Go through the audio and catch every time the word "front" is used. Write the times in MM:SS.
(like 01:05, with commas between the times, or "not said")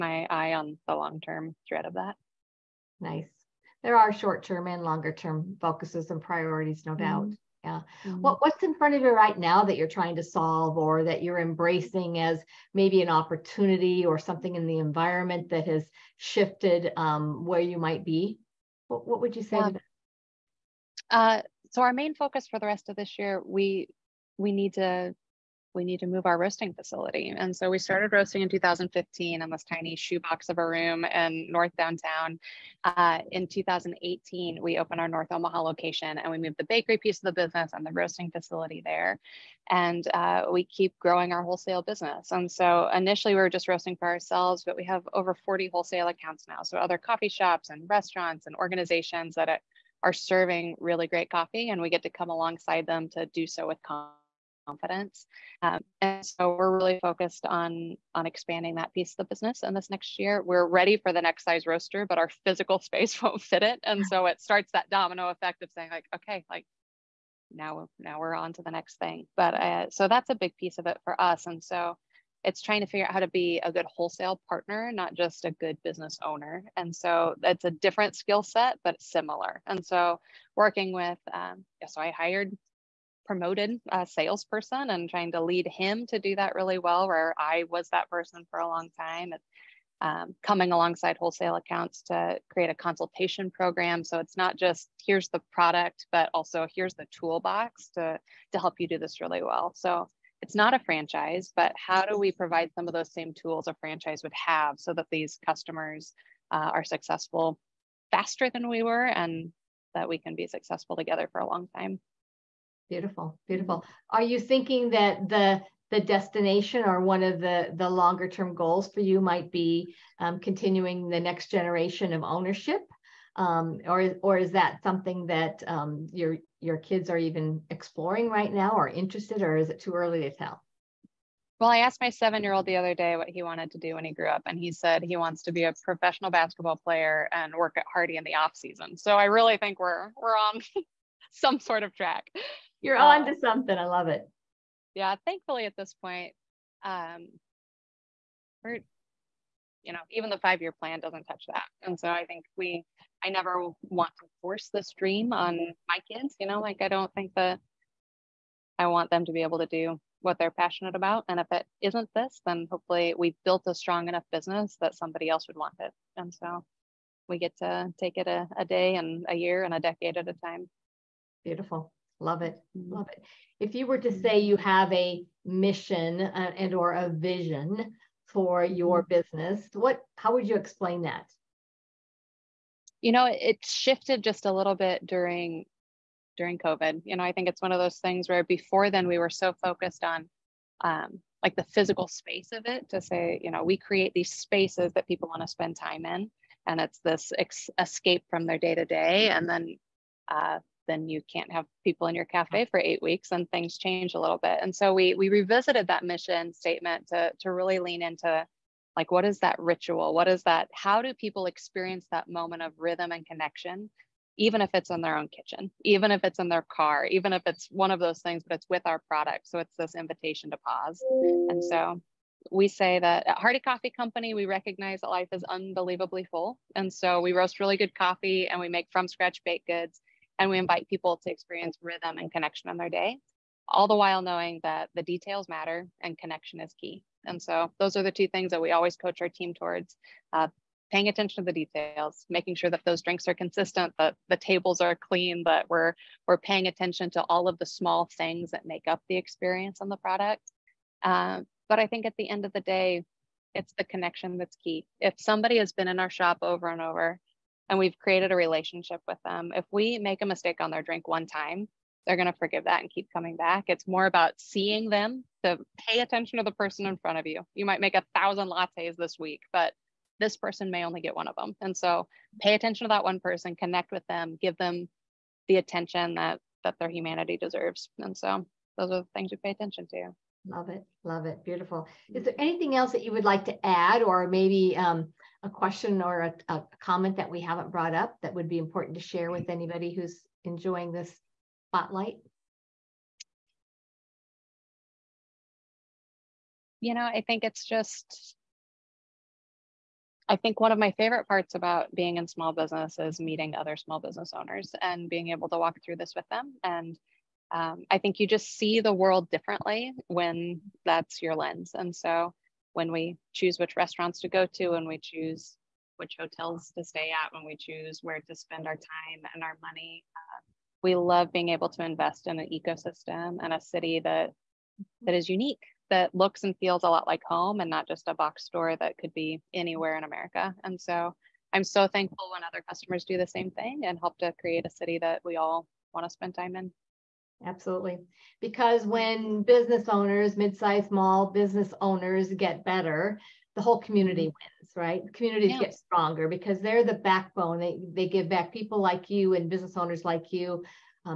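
00:08, 04:26.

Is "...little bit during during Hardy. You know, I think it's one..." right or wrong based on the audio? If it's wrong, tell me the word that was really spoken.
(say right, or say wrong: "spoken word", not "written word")
wrong: "COVID", not "Hardy".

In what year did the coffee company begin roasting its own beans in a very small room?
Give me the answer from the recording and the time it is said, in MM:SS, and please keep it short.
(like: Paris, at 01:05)
2015, at 00:28.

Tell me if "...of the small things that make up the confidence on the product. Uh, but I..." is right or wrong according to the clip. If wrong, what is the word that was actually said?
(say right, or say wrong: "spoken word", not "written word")
wrong: "experience", not "confidence".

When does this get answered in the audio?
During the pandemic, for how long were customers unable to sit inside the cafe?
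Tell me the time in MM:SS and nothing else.
03:22.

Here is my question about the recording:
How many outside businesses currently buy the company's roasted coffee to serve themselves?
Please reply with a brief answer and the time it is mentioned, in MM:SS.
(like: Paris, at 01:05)
over 40, at 00:45.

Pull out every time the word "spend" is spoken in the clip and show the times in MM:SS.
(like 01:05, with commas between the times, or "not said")
03:15, 05:18, 05:36.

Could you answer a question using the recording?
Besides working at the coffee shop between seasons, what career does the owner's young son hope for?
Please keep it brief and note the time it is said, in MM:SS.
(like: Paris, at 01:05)
professional basketball player, at 02:15.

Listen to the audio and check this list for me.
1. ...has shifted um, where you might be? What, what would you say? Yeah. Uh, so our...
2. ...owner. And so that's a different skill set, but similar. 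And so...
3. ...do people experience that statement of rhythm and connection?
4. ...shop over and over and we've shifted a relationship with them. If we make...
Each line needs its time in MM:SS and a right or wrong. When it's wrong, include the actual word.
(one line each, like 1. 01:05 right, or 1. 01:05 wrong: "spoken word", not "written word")
1. 00:15 right
2. 01:16 right
3. 03:31 wrong: "moment", not "statement"
4. 04:16 wrong: "created", not "shifted".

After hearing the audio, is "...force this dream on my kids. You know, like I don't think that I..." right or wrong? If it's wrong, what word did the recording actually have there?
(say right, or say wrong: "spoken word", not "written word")
right.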